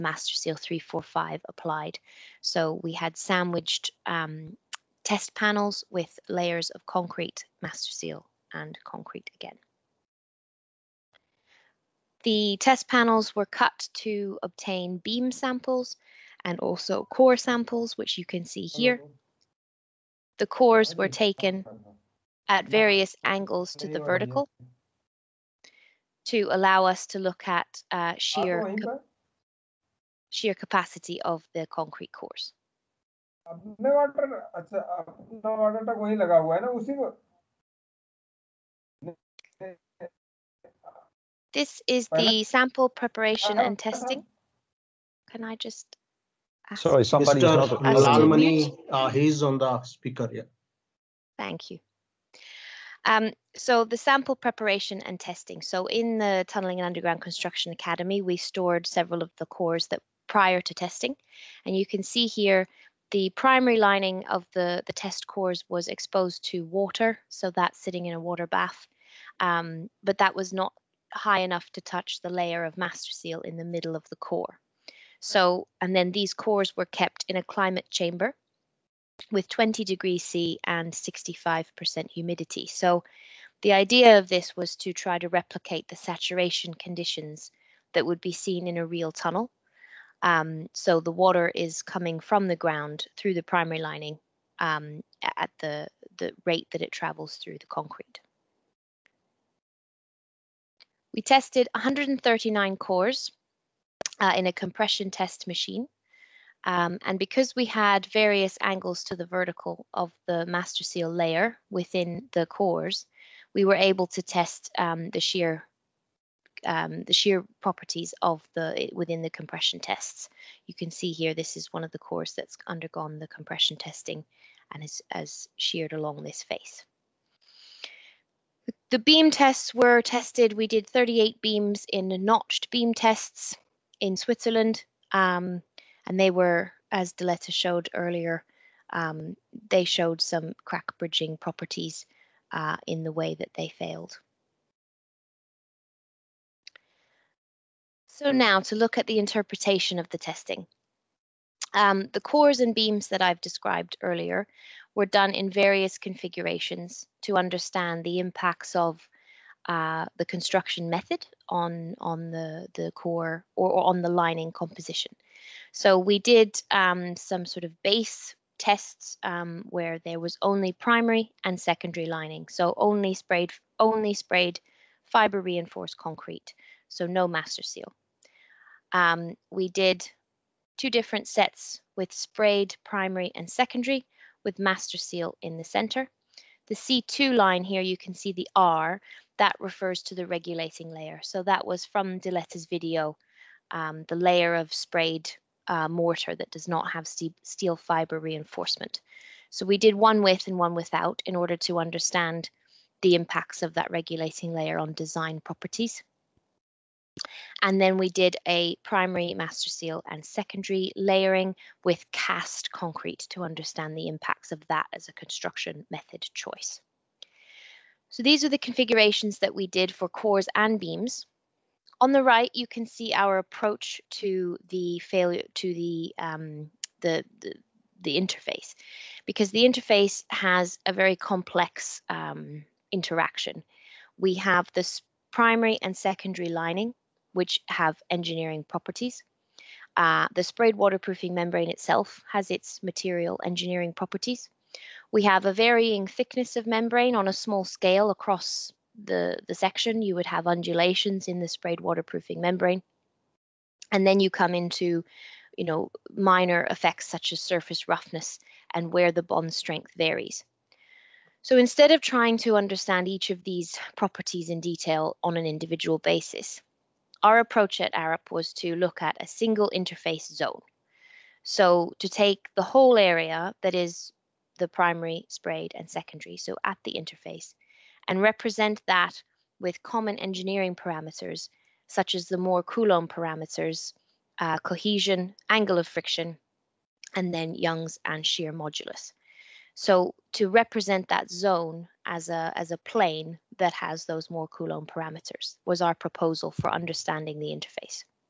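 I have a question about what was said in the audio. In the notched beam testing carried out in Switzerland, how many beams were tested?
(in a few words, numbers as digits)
38.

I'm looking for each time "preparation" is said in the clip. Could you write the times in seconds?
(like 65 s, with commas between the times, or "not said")
42 s, 54 s.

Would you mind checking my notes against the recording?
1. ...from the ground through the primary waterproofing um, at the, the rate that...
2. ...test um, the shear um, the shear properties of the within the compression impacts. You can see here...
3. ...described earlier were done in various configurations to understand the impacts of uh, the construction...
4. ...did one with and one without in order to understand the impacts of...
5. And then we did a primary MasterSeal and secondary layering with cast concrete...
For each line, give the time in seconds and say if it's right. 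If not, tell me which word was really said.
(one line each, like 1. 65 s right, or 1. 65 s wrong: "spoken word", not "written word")
1. 92 s wrong: "lining", not "waterproofing"
2. 114 s wrong: "tests", not "impacts"
3. 153 s right
4. 199 s right
5. 207 s right.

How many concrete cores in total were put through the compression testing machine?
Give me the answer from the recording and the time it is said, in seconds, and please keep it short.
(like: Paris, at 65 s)
139, at 101 s.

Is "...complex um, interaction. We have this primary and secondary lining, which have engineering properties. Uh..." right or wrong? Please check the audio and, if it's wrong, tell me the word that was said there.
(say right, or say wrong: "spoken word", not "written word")
right.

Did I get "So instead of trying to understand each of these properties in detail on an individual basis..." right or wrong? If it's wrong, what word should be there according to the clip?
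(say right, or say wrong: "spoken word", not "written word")
right.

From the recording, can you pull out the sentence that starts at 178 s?
Um, we did two different sets with sprayed primary and secondary with MasterSeal in the center.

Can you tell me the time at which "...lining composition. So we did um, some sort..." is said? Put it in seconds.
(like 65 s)
164 s.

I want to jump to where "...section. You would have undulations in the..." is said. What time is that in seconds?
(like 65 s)
249 s.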